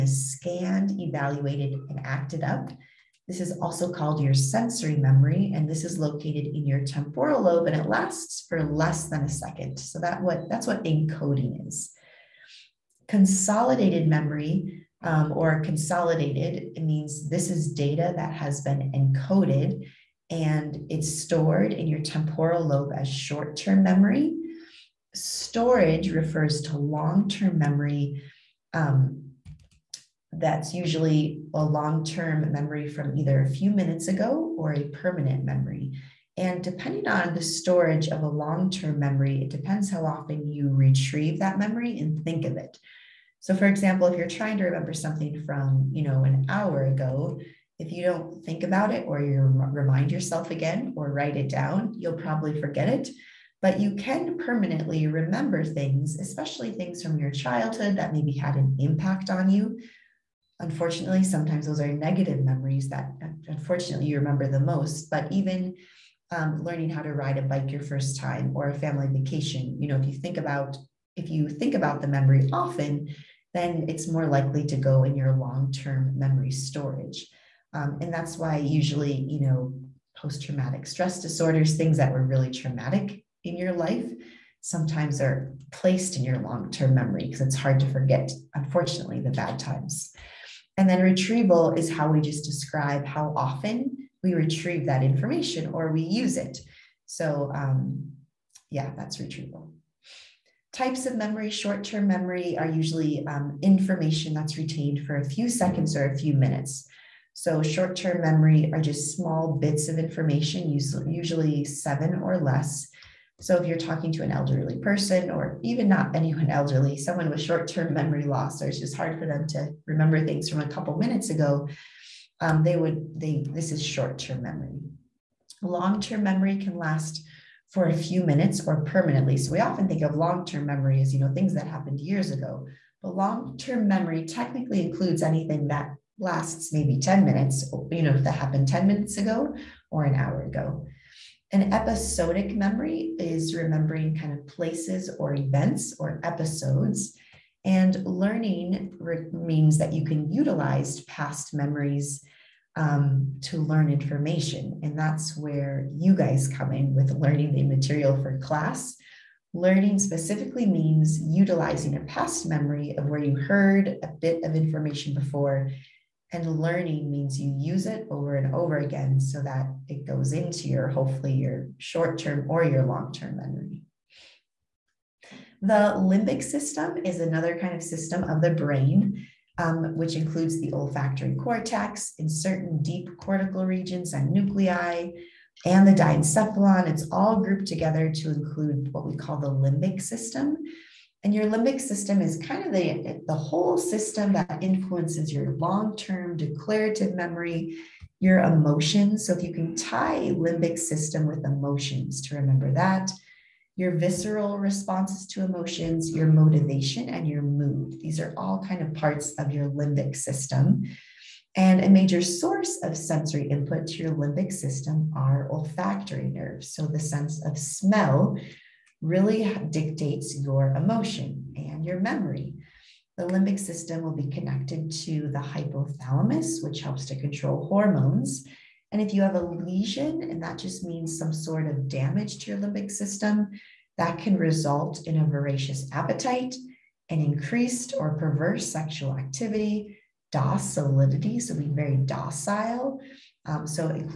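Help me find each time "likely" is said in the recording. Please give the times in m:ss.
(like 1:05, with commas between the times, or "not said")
1:14.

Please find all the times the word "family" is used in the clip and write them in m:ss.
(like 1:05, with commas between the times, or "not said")
1:08.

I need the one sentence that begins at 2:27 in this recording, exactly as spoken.
And learning re- means that you can utilize past memories um, to learn information.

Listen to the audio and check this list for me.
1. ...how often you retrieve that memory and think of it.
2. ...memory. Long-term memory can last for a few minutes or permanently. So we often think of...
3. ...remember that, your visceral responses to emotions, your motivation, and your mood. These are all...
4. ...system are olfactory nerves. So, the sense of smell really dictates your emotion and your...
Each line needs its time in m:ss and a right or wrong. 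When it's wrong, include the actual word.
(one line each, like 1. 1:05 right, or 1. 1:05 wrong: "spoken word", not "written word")
1. 0:39 right
2. 2:04 right
3. 3:22 right
4. 3:34 right.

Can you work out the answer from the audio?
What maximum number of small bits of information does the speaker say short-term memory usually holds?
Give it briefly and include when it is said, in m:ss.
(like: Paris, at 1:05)
7, at 1:51.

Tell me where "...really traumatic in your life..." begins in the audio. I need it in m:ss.
1:22.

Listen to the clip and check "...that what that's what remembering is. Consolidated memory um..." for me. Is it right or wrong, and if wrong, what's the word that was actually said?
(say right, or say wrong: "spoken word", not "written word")
wrong: "encoding", not "remembering".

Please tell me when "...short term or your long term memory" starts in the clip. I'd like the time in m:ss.
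2:51.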